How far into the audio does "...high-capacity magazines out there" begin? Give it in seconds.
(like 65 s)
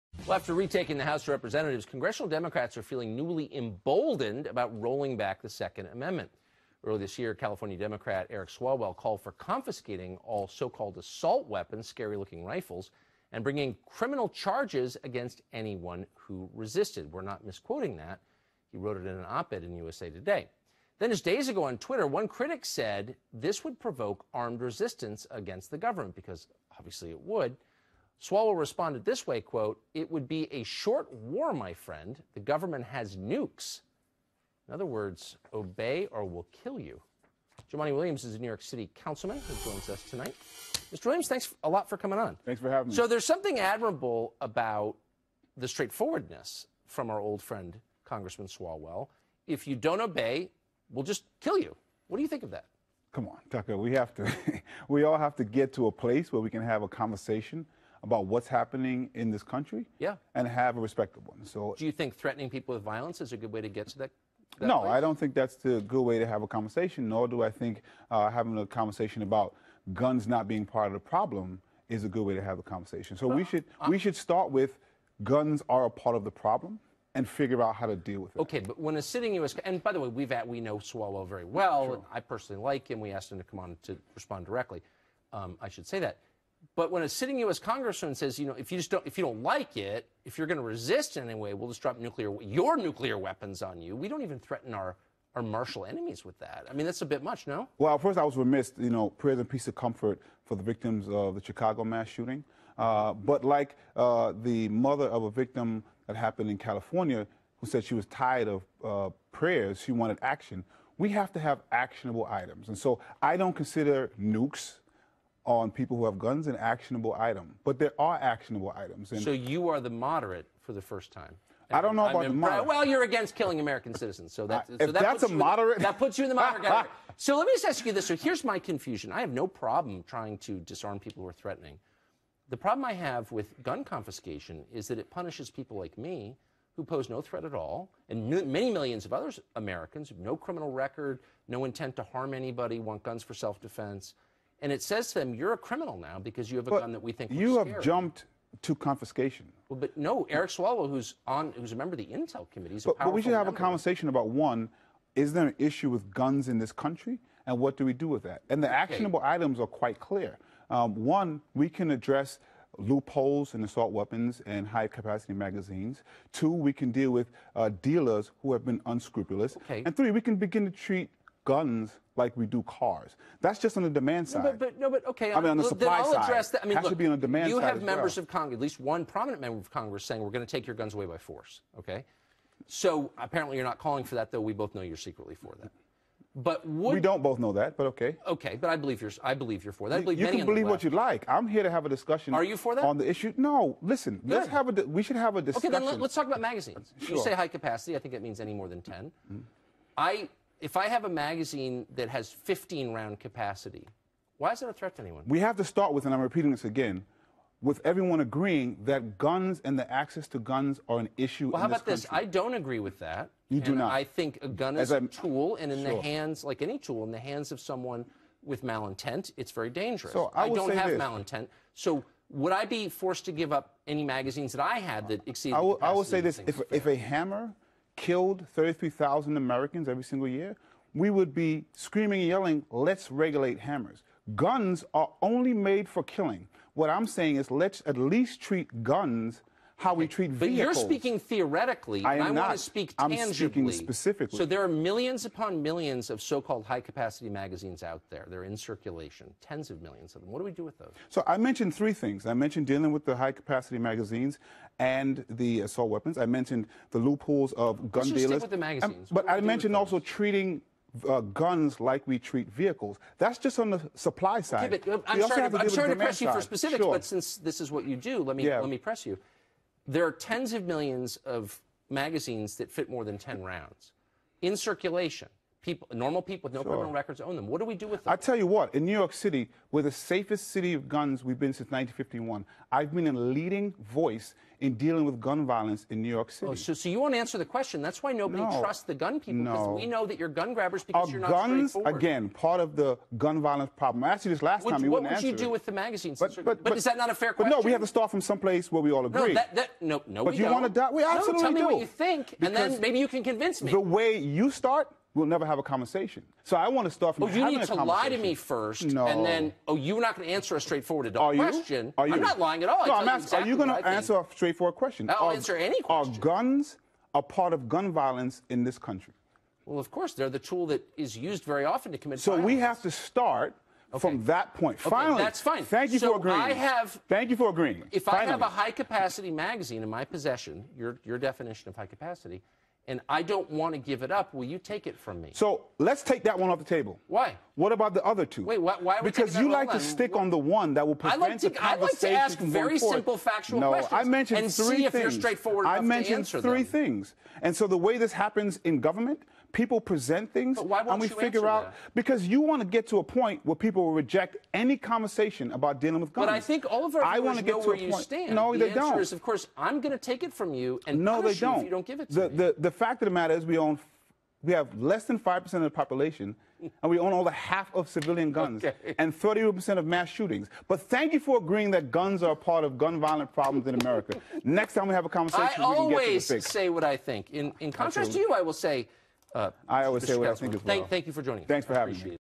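246 s.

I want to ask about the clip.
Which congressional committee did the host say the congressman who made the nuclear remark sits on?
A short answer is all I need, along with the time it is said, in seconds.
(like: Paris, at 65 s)
Intel Committee, at 152 s.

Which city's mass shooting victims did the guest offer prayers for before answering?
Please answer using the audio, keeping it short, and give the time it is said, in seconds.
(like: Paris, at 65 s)
Chicago, at 101 s.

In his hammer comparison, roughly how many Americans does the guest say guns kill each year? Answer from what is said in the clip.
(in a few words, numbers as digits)
33,000.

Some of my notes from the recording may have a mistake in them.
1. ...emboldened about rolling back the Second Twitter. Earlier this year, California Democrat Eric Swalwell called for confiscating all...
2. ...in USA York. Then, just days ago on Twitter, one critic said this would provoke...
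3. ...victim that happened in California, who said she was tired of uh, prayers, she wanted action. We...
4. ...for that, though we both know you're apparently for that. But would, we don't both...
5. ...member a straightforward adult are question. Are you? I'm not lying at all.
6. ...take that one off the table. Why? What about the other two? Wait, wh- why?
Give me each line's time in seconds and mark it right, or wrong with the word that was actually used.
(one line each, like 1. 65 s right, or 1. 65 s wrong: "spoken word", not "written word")
1. 3 s wrong: "Amendment", not "Twitter"
2. 19 s wrong: "Today", not "York"
3. 105 s right
4. 184 s wrong: "secretly", not "apparently"
5. 310 s wrong: "answer", not "member"
6. 336 s right.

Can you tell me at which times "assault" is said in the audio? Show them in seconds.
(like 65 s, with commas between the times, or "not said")
10 s, 163 s, 255 s.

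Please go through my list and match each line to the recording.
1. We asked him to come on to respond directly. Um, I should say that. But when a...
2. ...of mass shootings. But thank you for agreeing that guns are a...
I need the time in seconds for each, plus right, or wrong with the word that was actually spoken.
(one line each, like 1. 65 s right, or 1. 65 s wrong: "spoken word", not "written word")
1. 83 s right
2. 369 s right.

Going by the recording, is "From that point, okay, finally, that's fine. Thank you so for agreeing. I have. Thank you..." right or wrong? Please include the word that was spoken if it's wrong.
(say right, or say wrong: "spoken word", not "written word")
right.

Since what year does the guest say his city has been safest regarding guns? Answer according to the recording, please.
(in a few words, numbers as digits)
1951.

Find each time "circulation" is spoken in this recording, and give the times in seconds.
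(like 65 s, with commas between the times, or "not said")
248 s, 274 s.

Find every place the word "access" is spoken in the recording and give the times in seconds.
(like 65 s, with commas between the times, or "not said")
209 s.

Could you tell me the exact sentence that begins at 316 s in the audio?
Are guns a part of gun violence in this country?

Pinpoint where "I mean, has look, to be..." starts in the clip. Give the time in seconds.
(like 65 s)
176 s.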